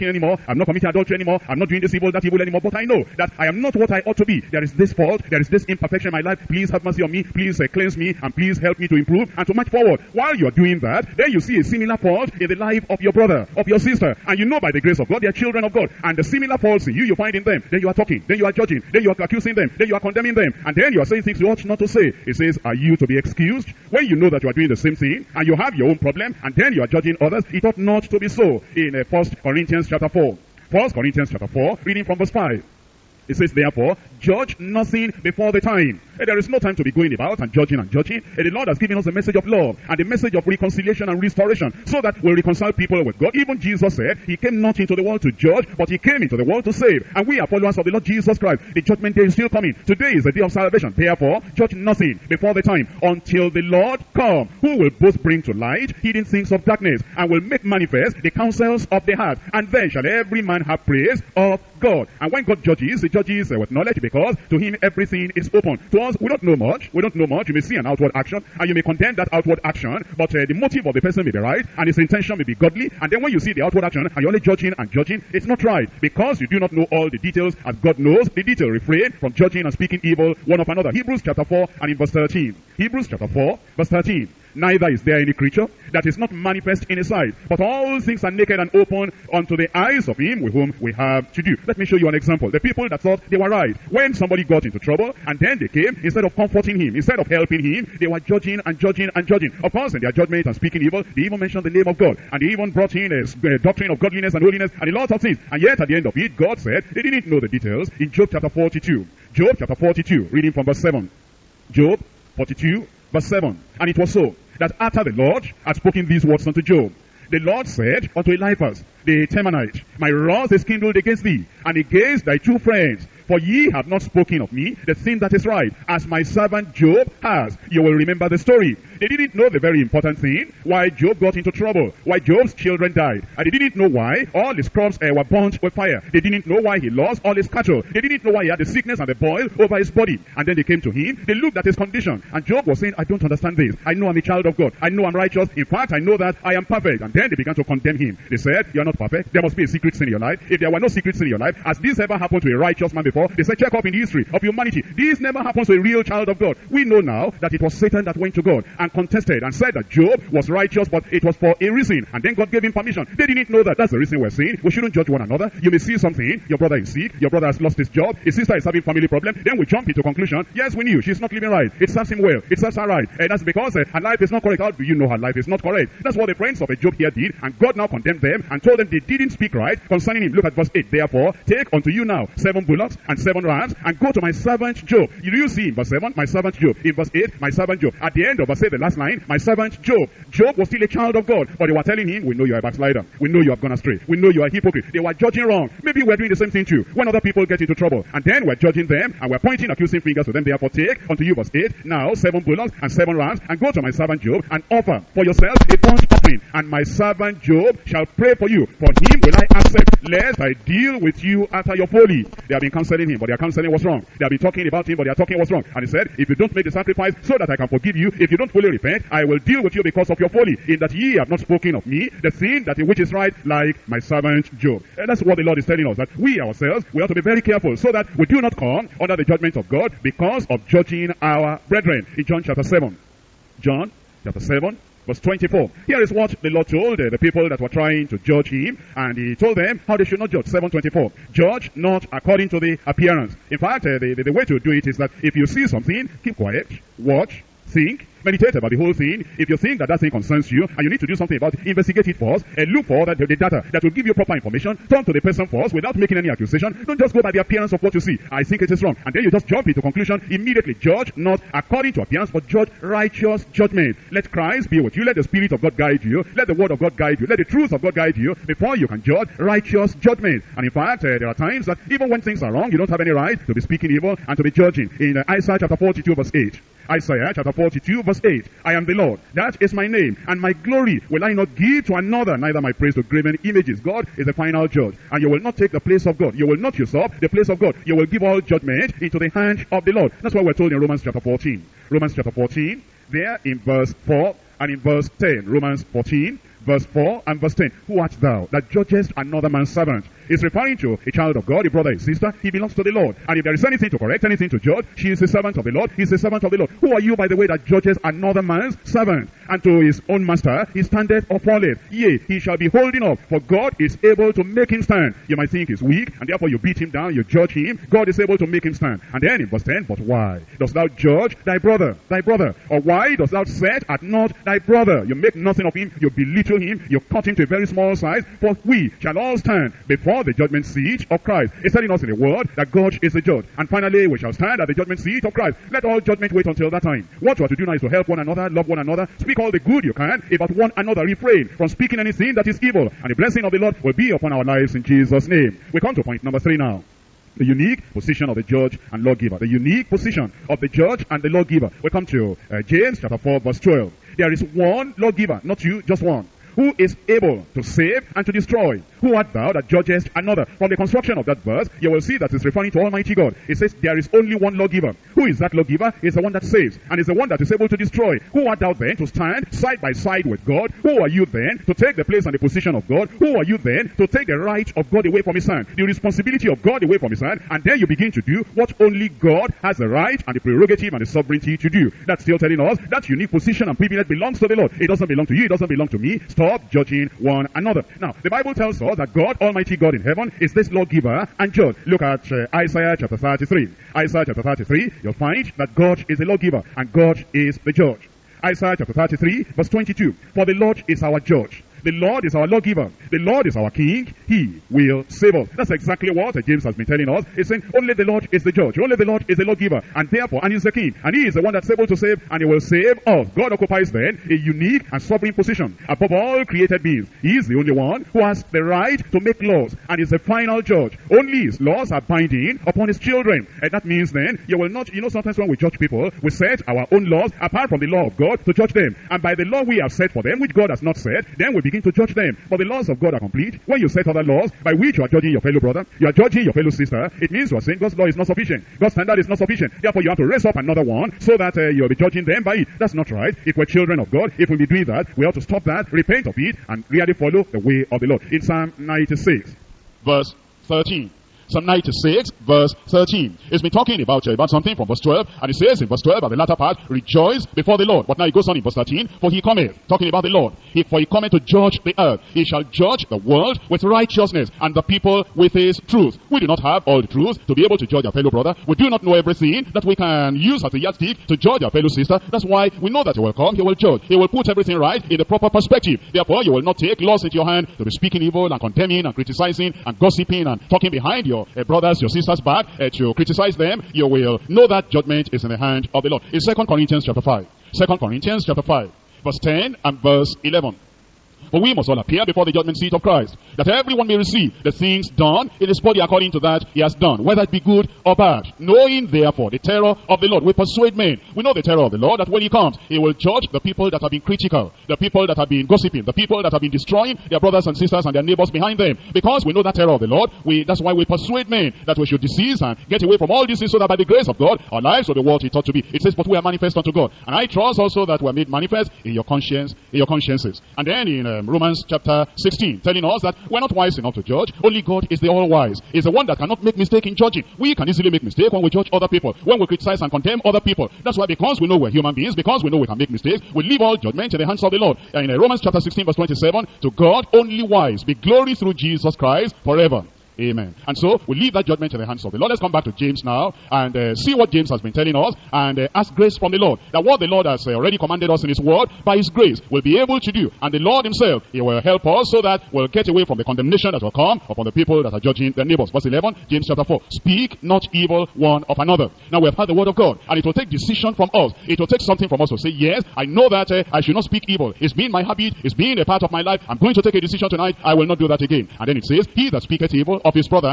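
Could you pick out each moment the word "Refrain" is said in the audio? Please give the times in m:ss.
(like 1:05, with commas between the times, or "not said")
1:18, 5:41.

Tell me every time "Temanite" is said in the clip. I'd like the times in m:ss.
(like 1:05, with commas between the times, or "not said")
1:59.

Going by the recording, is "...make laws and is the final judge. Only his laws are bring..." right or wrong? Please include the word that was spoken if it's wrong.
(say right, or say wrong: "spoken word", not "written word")
wrong: "binding", not "bring".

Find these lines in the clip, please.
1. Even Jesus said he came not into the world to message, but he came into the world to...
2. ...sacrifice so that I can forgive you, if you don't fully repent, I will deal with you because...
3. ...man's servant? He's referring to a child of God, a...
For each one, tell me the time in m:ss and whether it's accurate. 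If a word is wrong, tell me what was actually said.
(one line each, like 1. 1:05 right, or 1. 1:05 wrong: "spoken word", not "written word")
1. 0:43 wrong: "judge", not "message"
2. 3:36 right
3. 4:59 right.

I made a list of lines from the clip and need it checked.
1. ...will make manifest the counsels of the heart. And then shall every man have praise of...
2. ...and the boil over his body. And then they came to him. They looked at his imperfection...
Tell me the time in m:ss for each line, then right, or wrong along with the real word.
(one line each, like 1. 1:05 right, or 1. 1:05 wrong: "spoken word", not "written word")
1. 0:57 right
2. 2:18 wrong: "condition", not "imperfection".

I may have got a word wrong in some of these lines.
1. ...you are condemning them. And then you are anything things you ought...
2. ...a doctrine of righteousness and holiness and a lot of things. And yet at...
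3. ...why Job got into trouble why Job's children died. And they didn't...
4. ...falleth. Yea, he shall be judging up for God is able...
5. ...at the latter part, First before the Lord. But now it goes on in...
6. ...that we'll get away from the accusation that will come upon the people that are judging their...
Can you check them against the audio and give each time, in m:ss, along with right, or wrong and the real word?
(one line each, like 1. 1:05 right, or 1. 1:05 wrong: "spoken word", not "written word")
1. 0:19 wrong: "saying", not "anything"
2. 1:43 wrong: "godliness", not "righteousness"
3. 2:10 right
4. 5:11 wrong: "holding", not "judging"
5. 7:36 wrong: "Rejoice", not "First"
6. 9:12 wrong: "condemnation", not "accusation".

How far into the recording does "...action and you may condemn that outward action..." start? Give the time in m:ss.
1:08.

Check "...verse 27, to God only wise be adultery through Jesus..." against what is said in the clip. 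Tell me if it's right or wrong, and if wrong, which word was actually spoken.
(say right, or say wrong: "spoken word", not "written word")
wrong: "glory", not "adultery".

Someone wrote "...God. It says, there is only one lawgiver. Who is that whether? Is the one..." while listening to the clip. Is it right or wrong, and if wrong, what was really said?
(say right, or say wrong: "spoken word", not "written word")
wrong: "lawgiver", not "whether".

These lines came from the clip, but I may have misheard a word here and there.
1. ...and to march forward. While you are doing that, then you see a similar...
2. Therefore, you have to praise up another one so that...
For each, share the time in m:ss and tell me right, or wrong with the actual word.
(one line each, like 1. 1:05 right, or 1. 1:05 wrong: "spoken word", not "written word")
1. 0:09 right
2. 7:19 wrong: "raise", not "praise".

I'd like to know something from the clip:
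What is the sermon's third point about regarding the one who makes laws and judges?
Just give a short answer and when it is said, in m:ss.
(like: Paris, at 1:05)
unique position of the judge and lawgiver, at 5:49.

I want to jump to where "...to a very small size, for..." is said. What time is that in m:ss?
5:27.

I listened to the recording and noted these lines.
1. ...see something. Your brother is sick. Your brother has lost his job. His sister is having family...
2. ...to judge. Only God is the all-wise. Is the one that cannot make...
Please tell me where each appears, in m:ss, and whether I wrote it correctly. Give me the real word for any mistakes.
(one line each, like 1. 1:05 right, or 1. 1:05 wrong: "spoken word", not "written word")
1. 2:45 right
2. 8:44 right.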